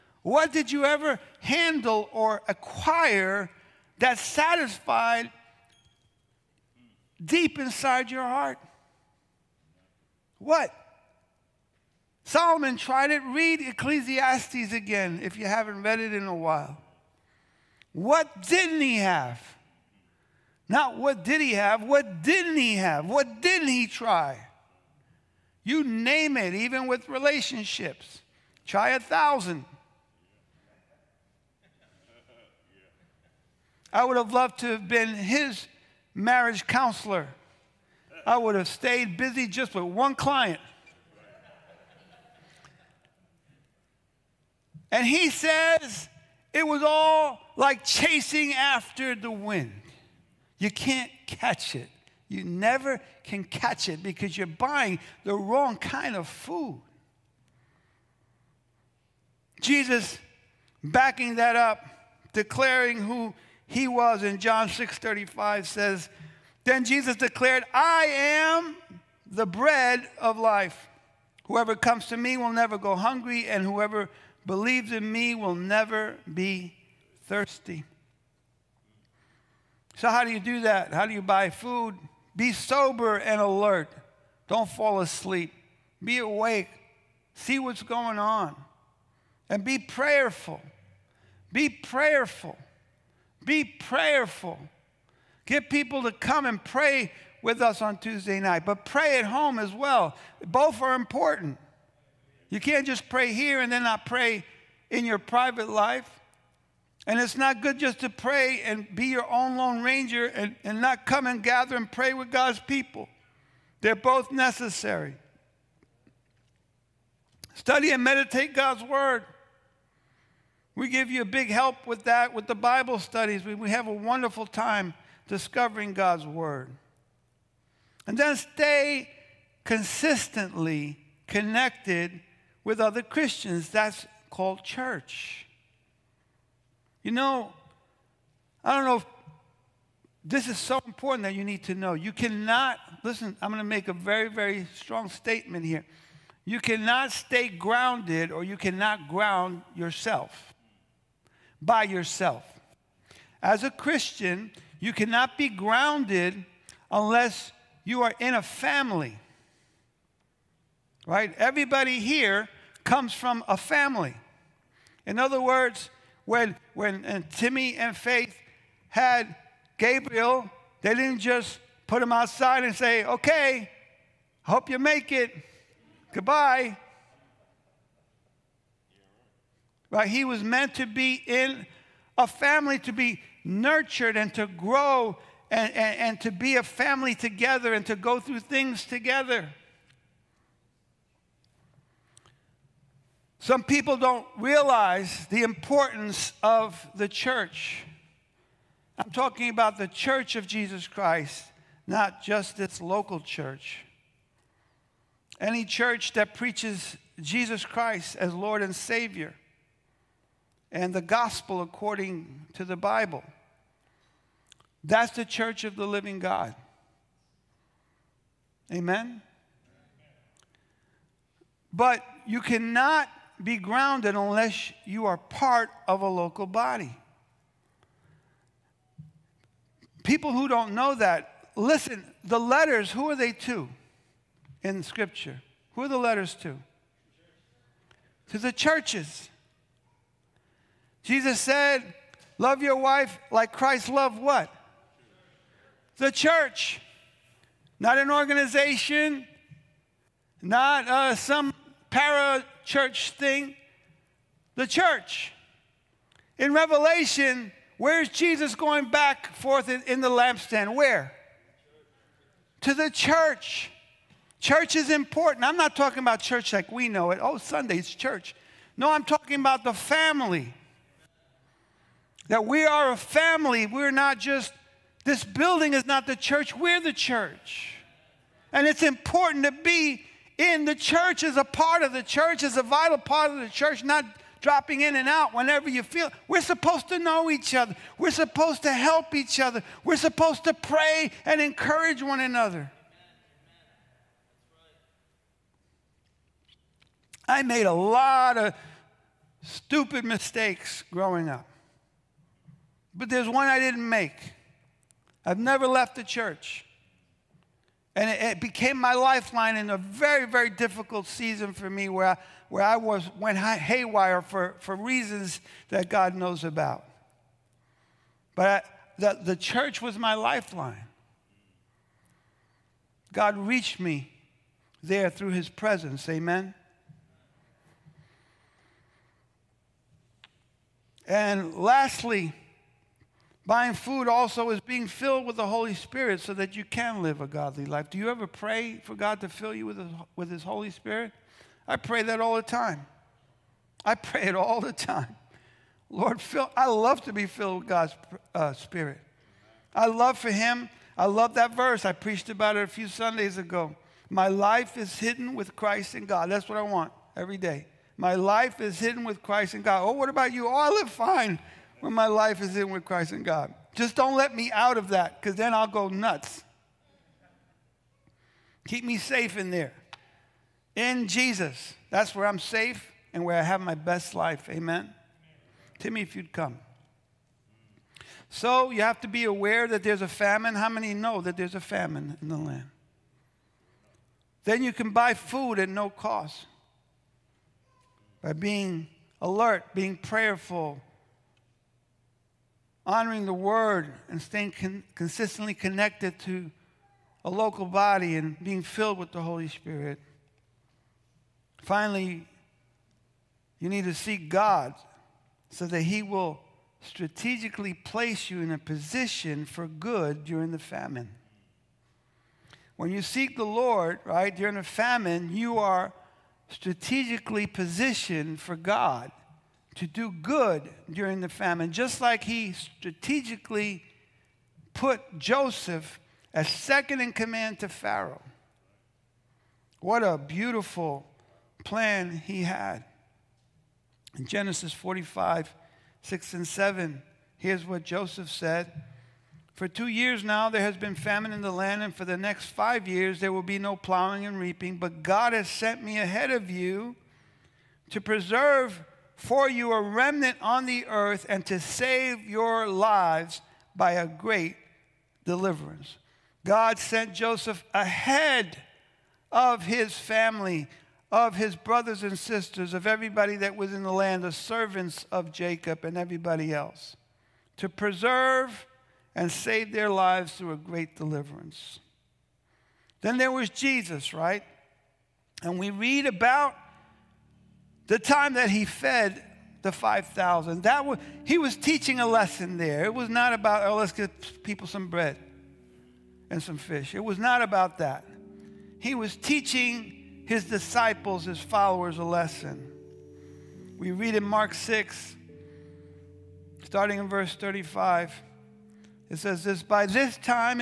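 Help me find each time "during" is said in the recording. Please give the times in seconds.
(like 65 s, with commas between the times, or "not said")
410 s, 414 s, 420 s.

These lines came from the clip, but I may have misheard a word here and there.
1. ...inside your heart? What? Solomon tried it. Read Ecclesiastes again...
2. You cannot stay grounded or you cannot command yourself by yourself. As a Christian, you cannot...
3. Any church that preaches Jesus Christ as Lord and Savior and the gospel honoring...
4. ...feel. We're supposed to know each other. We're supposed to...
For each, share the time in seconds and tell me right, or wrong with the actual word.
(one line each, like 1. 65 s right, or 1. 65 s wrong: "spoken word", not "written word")
1. 7 s right
2. 146 s wrong: "ground", not "command"
3. 205 s wrong: "according", not "honoring"
4. 285 s right.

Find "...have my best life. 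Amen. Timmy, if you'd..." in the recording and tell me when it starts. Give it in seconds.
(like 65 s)
373 s.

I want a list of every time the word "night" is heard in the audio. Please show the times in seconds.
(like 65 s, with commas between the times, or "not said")
98 s.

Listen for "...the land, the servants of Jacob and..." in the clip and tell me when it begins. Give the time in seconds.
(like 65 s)
463 s.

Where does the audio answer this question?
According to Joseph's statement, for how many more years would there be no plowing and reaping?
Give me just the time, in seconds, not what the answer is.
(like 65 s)
442 s.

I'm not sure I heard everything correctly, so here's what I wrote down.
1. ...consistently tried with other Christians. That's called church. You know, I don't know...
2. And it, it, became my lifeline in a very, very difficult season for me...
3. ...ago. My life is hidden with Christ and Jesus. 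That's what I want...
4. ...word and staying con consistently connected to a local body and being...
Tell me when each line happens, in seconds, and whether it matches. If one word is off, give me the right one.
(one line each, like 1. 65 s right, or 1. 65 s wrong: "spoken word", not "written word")
1. 129 s wrong: "connected", not "tried"
2. 307 s right
3. 353 s wrong: "God", not "Jesus"
4. 393 s right.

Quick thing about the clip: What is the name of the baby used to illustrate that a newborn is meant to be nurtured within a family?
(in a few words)
Gabriel.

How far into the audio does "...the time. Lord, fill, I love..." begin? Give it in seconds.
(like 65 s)
344 s.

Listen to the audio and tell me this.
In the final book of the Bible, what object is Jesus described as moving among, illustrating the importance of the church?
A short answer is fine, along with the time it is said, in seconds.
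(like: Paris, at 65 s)
the lampstand, at 259 s.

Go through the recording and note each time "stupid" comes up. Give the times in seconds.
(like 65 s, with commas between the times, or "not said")
299 s.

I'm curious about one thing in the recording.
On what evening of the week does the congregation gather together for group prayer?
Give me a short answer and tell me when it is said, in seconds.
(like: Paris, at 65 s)
Tuesday, at 97 s.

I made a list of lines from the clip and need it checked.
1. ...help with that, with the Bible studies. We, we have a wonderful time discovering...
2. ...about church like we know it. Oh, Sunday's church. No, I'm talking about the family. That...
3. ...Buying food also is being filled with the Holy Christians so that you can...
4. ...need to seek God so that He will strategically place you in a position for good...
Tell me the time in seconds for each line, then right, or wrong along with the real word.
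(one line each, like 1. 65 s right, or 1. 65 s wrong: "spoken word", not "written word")
1. 121 s right
2. 265 s right
3. 333 s wrong: "Spirit", not "Christians"
4. 403 s right.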